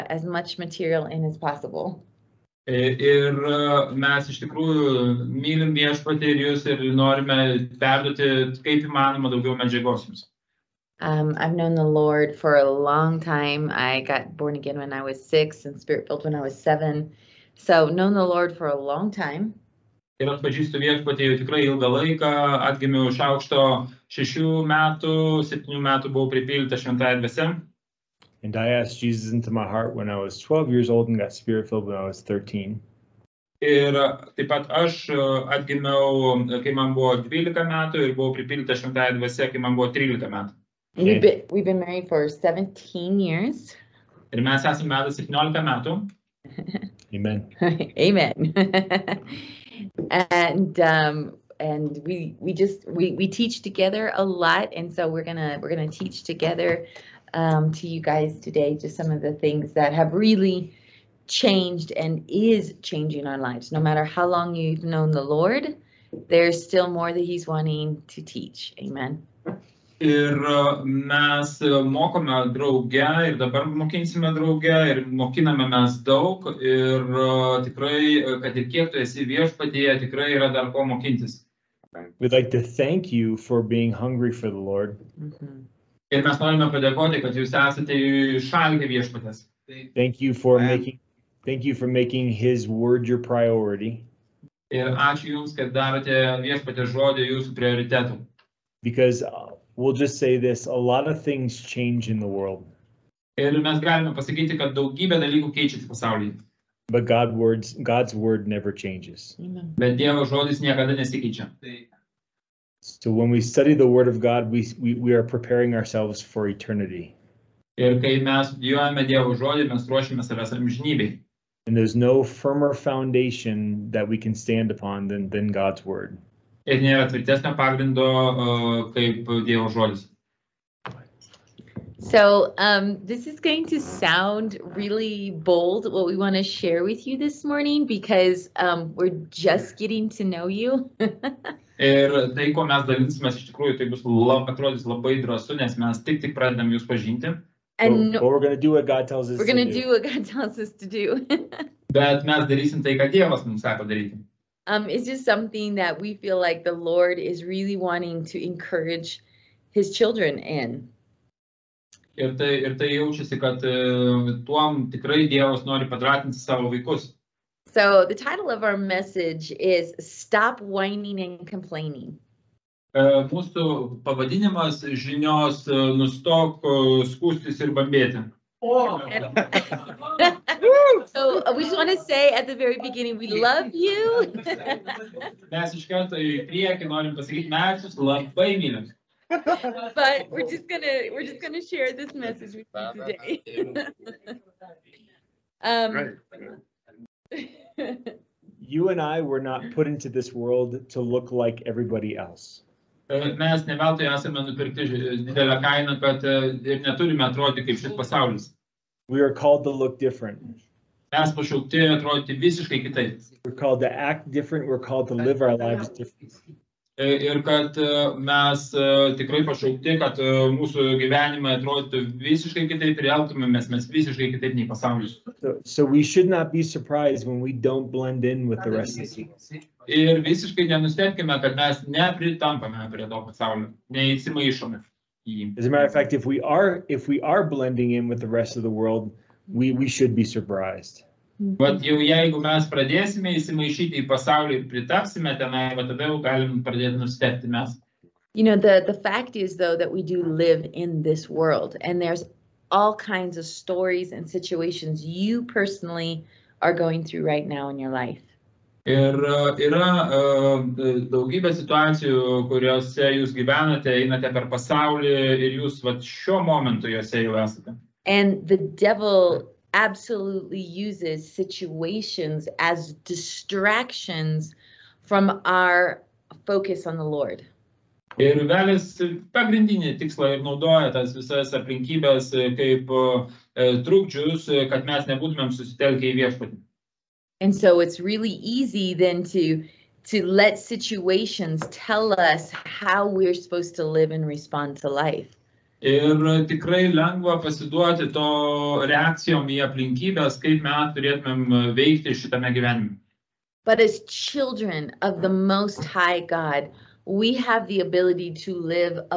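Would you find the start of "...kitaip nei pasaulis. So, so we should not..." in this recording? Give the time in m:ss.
3:44.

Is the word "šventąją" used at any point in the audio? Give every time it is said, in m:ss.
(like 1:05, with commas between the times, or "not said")
0:26, 0:38.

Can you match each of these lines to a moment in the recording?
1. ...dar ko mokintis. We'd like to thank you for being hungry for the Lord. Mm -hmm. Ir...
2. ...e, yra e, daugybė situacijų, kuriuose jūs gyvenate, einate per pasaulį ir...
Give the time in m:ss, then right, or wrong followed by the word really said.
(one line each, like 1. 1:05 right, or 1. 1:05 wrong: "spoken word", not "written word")
1. 1:20 right
2. 4:19 right.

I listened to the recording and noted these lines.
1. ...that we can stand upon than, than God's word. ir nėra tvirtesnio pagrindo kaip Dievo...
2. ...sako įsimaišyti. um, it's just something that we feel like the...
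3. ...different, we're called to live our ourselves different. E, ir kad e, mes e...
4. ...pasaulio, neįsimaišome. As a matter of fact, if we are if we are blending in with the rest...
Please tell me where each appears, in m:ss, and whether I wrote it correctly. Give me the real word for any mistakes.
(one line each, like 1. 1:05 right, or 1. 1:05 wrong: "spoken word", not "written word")
1. 2:03 right
2. 2:33 wrong: "daryti", not "įsimaišyti"
3. 3:34 wrong: "lives", not "ourselves"
4. 3:53 right.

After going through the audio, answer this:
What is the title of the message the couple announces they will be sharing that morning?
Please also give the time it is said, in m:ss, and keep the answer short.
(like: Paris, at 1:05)
Stop Whining and Complaining, at 2:49.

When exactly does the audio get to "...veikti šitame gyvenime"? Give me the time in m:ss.
5:01.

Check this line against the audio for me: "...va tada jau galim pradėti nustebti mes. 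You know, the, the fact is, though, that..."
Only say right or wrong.
right.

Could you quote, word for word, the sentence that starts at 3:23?
Mes esame nupirkti didelę kainą, ir neturime atrodyti kaip šis pasaulis.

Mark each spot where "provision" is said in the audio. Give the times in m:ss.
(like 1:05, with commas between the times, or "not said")
not said.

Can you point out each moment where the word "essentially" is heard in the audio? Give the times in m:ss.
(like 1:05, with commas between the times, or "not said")
not said.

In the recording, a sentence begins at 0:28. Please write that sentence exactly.
And I asked Jesus into my heart when I was 12 years old and got spirit filled when I was 13.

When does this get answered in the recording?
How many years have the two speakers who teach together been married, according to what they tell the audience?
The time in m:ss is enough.
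0:42.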